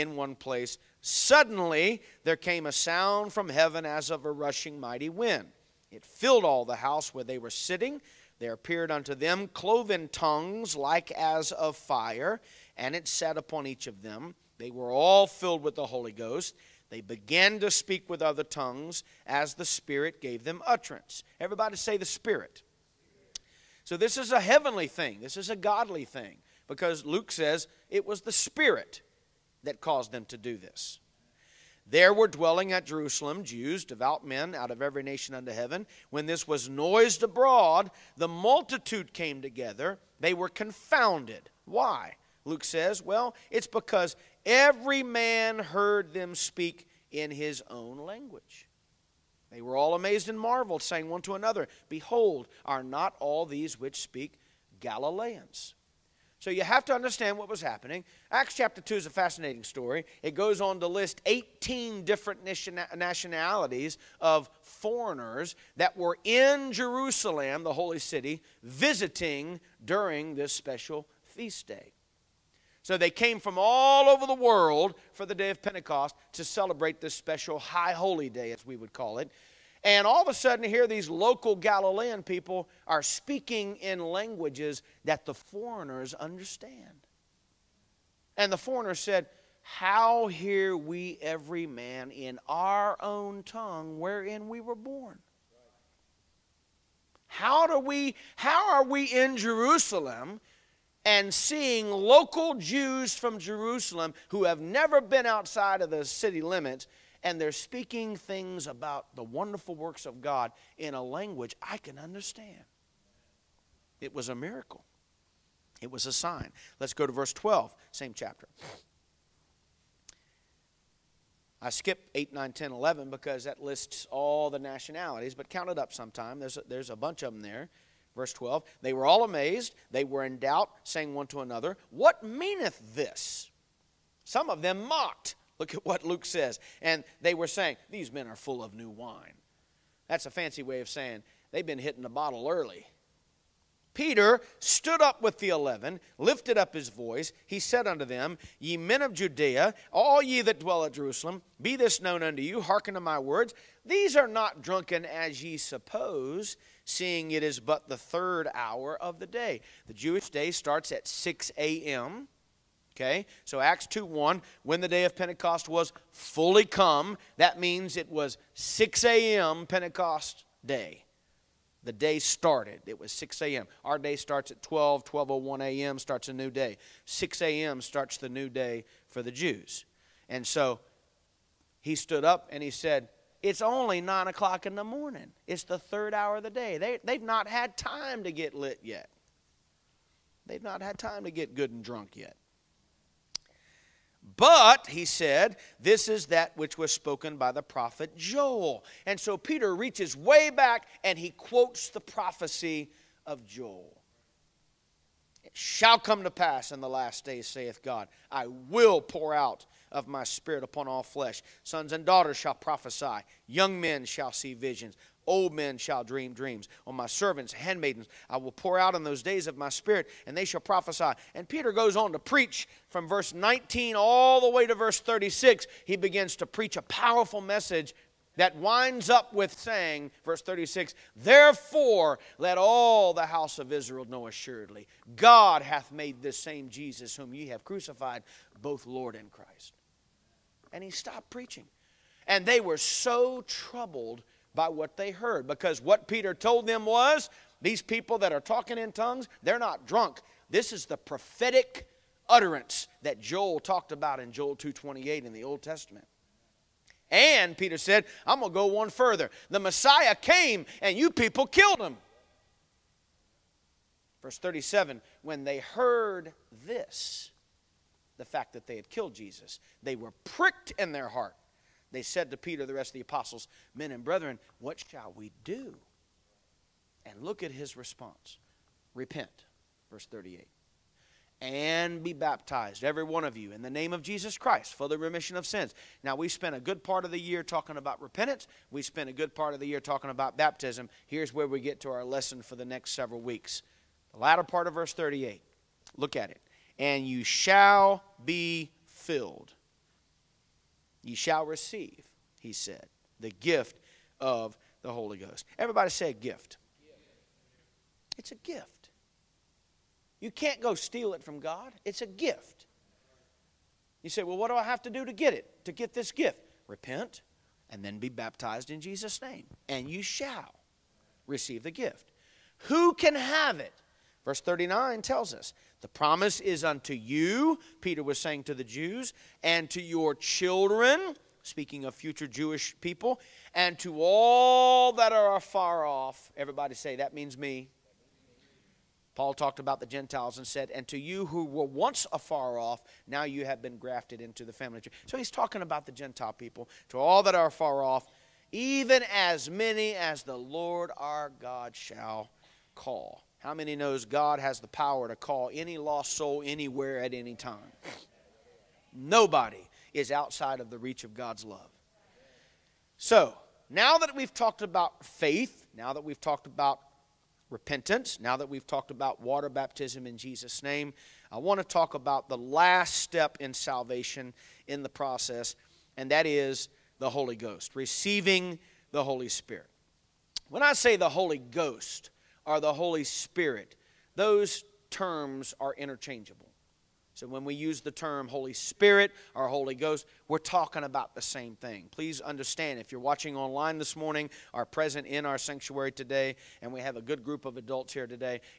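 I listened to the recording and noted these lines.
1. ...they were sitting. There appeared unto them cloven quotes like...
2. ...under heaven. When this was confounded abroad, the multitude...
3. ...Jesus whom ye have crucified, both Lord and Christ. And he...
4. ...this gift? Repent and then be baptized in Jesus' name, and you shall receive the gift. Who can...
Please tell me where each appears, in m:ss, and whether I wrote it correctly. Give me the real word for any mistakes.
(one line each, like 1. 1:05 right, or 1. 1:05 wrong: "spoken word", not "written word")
1. 0:07 wrong: "tongues", not "quotes"
2. 0:35 wrong: "noised", not "confounded"
3. 3:56 right
4. 5:15 right.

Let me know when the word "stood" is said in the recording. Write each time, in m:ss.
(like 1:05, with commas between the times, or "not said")
2:24, 3:01.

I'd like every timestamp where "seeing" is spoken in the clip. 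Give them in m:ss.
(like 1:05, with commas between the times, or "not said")
1:41, 2:36.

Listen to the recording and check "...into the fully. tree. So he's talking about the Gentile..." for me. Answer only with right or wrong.
wrong.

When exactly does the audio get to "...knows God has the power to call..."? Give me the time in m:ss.
5:53.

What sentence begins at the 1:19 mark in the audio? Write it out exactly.
And all of a sudden, here these local Galilean people are speaking in languages that the foreigners understand.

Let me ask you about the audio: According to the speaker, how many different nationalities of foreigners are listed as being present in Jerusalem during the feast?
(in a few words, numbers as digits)
18.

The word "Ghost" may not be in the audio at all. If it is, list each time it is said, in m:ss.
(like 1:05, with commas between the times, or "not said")
0:16, 5:05, 6:17, 6:21, 6:29.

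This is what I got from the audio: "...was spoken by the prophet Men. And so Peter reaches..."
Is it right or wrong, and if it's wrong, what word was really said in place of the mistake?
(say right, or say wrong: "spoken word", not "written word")
wrong: "Joel", not "Men".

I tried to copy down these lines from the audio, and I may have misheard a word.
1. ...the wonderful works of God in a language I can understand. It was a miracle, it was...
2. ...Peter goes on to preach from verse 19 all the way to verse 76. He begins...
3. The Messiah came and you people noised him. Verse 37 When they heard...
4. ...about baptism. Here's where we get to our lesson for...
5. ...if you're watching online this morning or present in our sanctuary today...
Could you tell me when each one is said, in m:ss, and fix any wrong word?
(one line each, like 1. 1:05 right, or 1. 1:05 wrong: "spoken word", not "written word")
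1. 1:49 right
2. 3:41 wrong: "36", not "76"
3. 4:19 wrong: "killed", not "noised"
4. 4:50 right
5. 6:32 right.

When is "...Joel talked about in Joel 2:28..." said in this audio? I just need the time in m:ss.
4:13.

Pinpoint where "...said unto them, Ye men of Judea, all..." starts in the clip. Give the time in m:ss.
2:27.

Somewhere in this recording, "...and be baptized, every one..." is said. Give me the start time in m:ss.
4:41.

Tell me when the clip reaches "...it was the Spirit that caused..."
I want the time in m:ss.
0:27.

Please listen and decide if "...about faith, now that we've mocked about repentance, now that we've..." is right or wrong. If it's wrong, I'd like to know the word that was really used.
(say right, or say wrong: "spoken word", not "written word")
wrong: "talked", not "mocked".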